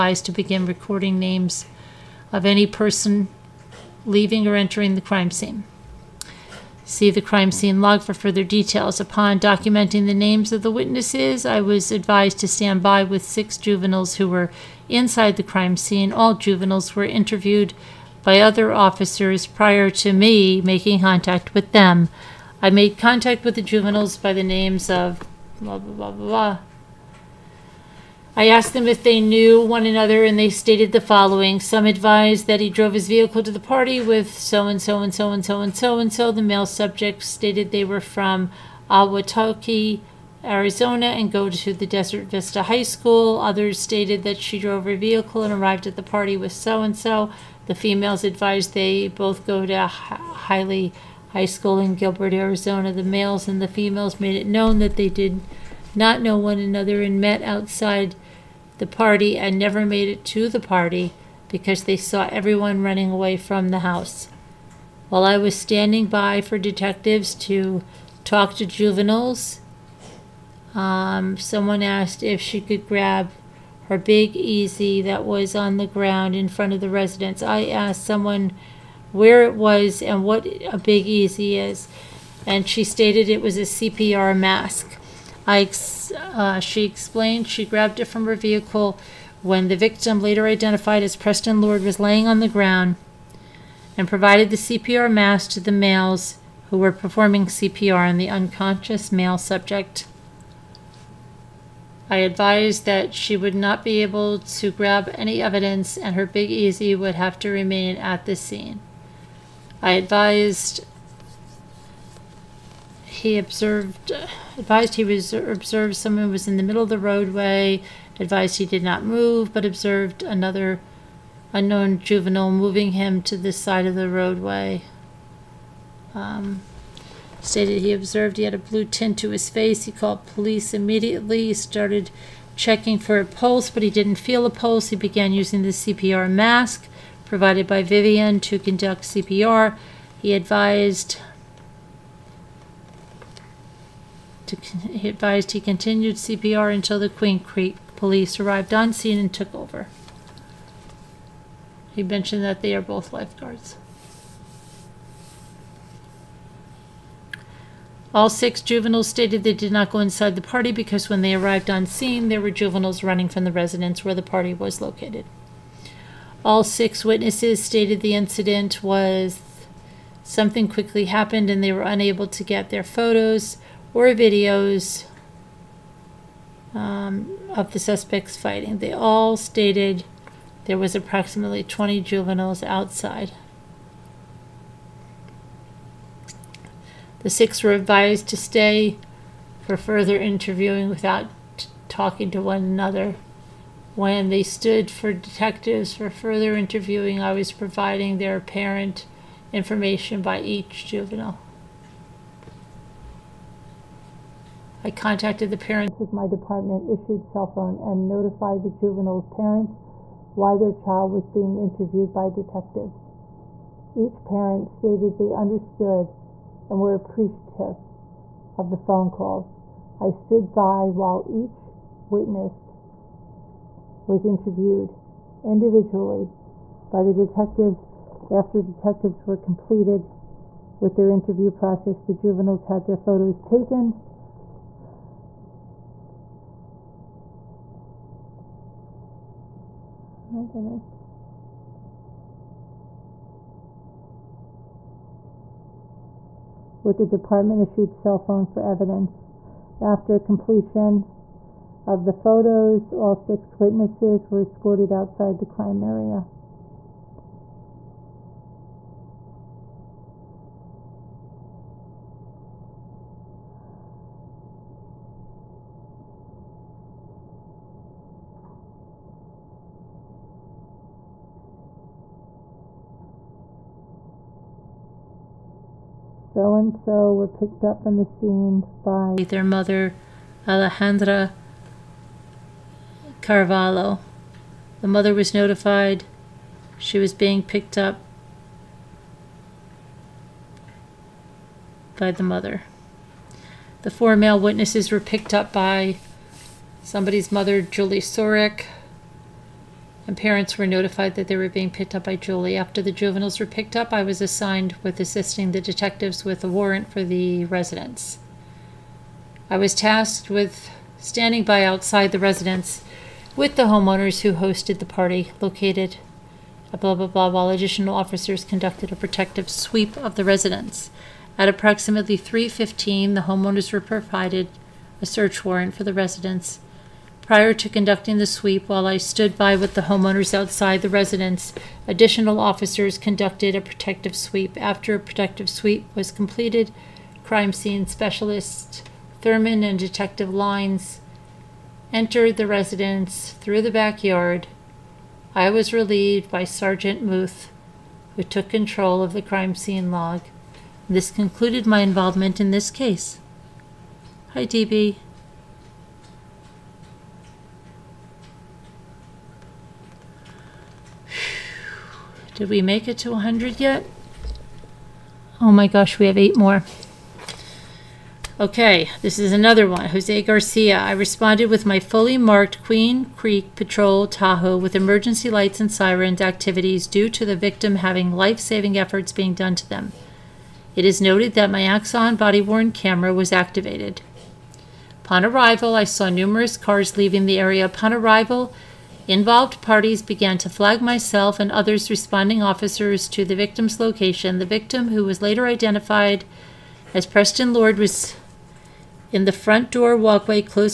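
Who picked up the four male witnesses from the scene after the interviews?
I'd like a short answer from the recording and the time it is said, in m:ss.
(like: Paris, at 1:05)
Julie Sorek, at 4:57.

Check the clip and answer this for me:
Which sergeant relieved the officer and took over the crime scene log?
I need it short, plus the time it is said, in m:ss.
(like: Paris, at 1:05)
Sergeant Muth, at 5:46.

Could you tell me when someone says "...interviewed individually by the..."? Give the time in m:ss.
3:44.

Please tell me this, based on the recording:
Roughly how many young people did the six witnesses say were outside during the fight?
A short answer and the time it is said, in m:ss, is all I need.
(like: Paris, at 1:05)
20, at 3:01.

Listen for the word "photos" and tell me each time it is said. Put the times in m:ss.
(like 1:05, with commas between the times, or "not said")
2:52, 3:52, 4:12.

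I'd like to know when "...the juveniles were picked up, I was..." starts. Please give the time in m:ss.
5:02.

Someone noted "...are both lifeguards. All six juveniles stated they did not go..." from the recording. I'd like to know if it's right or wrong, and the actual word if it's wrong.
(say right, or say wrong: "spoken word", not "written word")
right.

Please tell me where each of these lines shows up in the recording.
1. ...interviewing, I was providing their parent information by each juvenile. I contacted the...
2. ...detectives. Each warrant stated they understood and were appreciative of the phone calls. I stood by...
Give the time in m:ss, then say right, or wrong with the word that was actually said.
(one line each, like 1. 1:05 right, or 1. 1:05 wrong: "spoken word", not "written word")
1. 3:16 right
2. 3:32 wrong: "parent", not "warrant".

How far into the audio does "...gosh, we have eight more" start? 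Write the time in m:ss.
6:05.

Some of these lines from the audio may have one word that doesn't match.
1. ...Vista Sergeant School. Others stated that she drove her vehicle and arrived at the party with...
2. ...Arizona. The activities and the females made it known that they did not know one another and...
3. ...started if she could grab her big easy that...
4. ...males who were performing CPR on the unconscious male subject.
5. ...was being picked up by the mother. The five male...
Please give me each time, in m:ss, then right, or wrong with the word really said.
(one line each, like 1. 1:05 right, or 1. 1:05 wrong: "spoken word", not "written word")
1. 0:42 wrong: "High", not "Sergeant"
2. 0:52 wrong: "males", not "activities"
3. 1:11 wrong: "asked", not "started"
4. 1:35 right
5. 4:46 wrong: "four", not "five".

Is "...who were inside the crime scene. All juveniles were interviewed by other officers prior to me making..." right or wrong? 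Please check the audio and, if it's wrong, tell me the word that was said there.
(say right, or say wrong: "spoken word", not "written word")
right.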